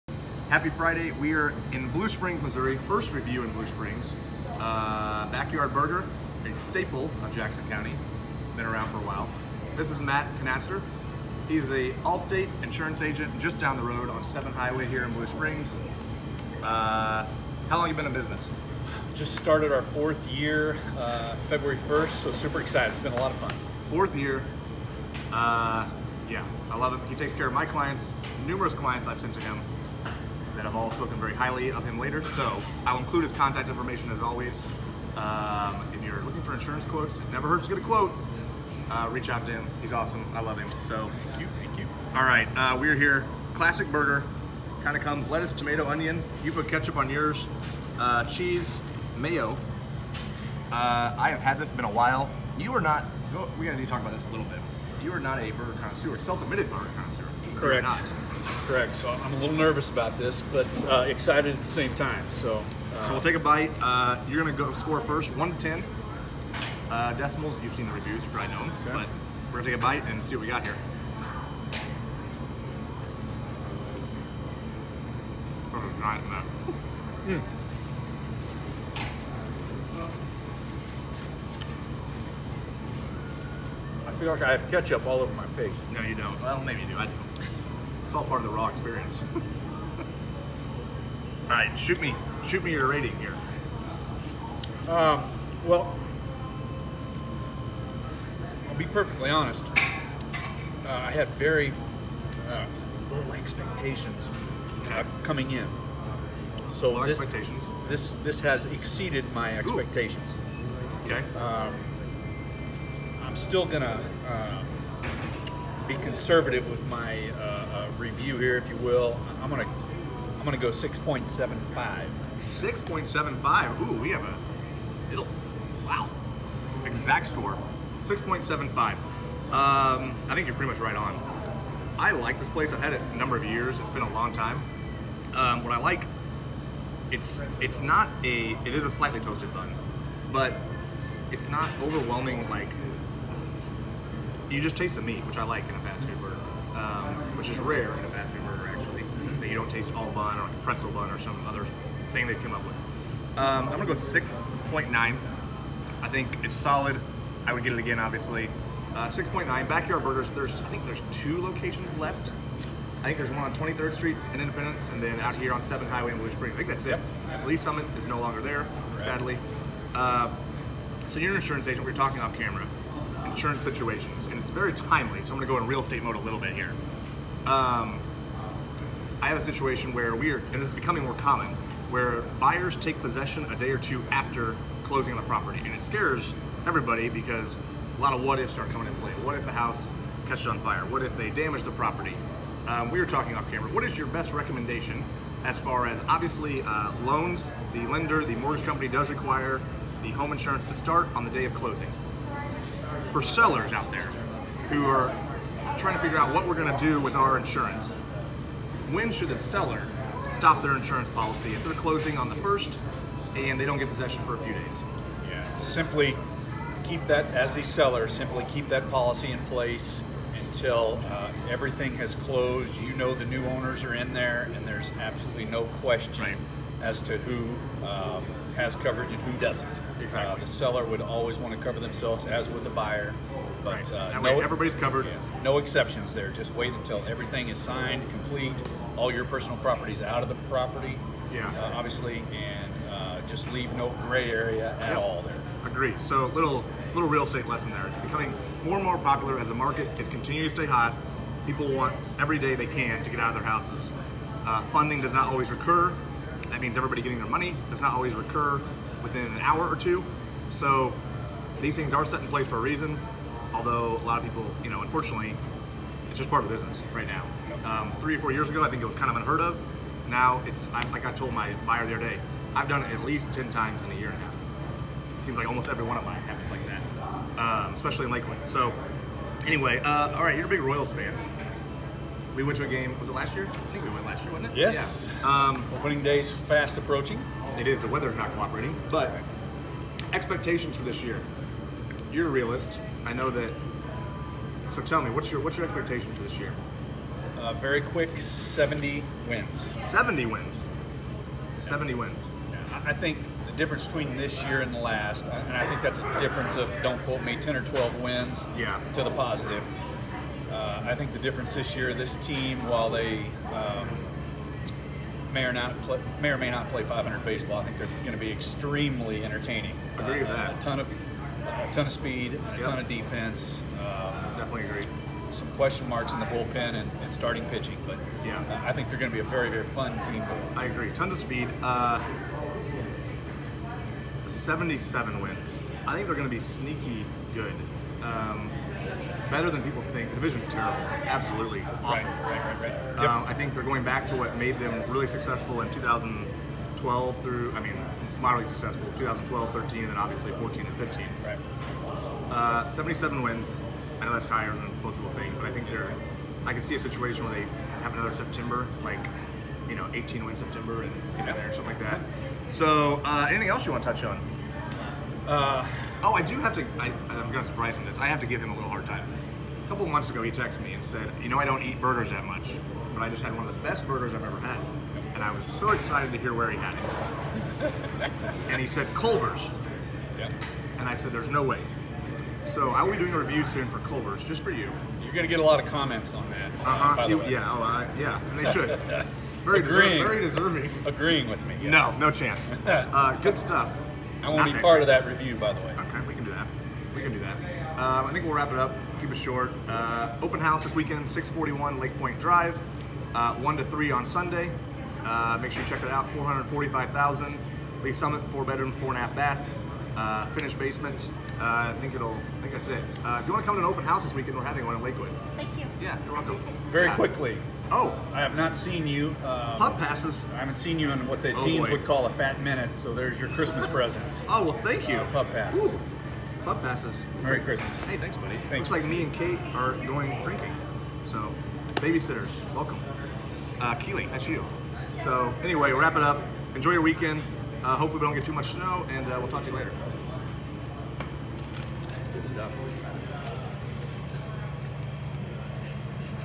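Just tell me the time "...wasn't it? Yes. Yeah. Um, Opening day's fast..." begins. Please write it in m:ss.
4:44.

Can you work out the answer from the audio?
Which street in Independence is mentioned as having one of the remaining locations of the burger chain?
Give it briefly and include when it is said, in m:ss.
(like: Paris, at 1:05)
23rd Street, at 2:43.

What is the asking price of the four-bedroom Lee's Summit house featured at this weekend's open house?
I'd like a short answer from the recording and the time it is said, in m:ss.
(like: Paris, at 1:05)
445,000, at 6:46.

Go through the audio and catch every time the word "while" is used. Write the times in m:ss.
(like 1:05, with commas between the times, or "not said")
0:09, 0:51, 5:12.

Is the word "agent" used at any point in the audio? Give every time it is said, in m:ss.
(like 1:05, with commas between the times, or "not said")
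0:13, 2:51.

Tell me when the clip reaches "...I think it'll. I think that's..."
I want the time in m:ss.
6:51.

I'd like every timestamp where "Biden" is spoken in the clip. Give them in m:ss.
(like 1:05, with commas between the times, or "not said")
not said.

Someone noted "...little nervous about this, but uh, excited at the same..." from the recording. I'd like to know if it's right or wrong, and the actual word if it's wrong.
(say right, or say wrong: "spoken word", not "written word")
right.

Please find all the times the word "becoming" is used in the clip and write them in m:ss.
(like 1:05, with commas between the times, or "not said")
3:00, 4:08.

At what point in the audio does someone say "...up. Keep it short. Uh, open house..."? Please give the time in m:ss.
6:38.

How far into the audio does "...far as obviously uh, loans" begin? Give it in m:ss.
3:15.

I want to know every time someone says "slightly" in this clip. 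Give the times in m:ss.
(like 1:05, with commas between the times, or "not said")
2:18.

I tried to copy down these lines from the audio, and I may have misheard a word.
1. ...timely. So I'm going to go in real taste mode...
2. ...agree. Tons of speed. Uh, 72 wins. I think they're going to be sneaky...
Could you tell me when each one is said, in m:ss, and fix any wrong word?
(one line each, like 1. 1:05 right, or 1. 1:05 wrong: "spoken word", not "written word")
1. 2:54 wrong: "estate", not "taste"
2. 5:30 wrong: "77", not "72".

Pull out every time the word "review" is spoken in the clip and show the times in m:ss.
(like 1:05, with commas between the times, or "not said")
0:03, 1:07, 1:57, 6:23, 6:35.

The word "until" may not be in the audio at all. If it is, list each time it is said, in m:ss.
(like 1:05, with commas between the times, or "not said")
3:40, 3:56.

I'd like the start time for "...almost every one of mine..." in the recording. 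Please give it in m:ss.
4:35.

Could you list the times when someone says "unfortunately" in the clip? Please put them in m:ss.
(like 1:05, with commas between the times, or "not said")
4:24.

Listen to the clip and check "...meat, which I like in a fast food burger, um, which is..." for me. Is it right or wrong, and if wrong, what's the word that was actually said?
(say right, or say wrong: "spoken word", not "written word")
right.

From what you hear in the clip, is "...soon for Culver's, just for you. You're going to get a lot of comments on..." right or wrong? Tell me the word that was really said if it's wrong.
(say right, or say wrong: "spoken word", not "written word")
right.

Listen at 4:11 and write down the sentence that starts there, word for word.
People want every day they can to get out of their houses.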